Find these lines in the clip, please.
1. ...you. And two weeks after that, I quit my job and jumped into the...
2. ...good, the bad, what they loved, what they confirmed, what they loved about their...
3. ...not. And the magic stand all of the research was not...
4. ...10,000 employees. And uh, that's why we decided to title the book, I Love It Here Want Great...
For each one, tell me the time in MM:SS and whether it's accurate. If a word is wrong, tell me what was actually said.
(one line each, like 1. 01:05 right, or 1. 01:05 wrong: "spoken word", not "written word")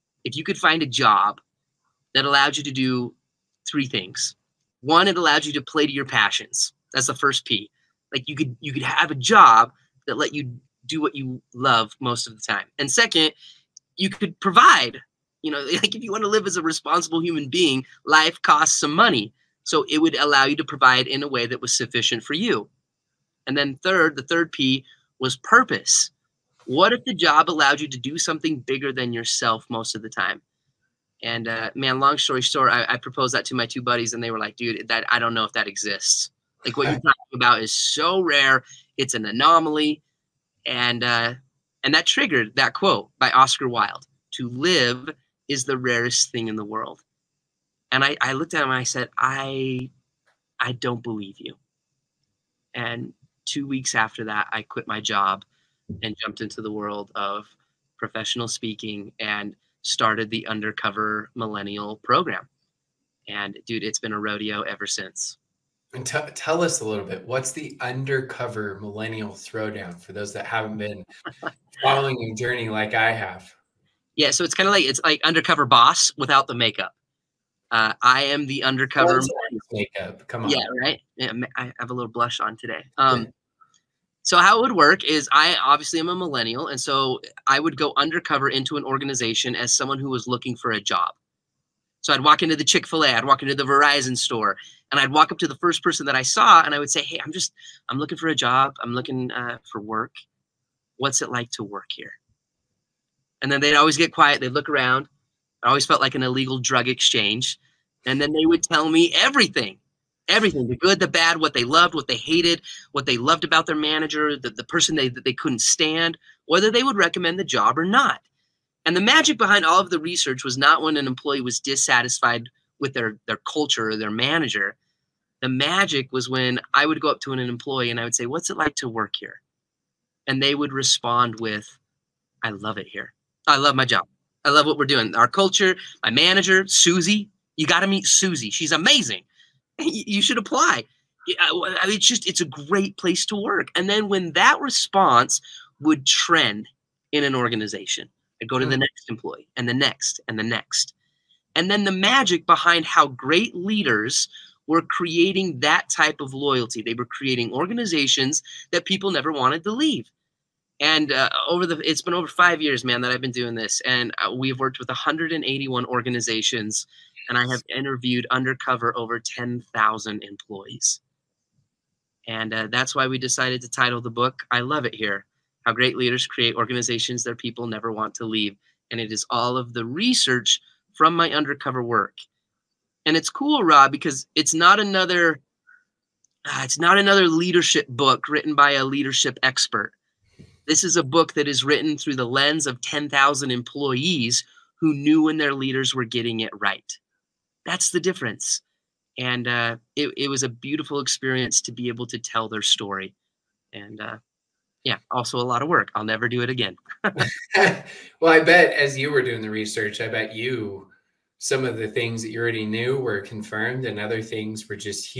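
1. 00:51 right
2. 01:50 wrong: "hated", not "confirmed"
3. 01:57 wrong: "behind", not "stand"
4. 02:49 wrong: "How", not "Want".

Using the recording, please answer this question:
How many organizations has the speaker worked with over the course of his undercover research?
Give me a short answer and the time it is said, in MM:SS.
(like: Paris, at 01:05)
181, at 02:44.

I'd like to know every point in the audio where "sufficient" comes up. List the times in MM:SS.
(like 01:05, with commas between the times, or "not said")
00:21.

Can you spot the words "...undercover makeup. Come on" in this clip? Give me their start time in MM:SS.
01:18.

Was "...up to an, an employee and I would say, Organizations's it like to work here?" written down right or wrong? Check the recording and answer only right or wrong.
wrong.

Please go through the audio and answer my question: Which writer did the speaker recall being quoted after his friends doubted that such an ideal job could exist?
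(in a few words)
Oscar Wilde.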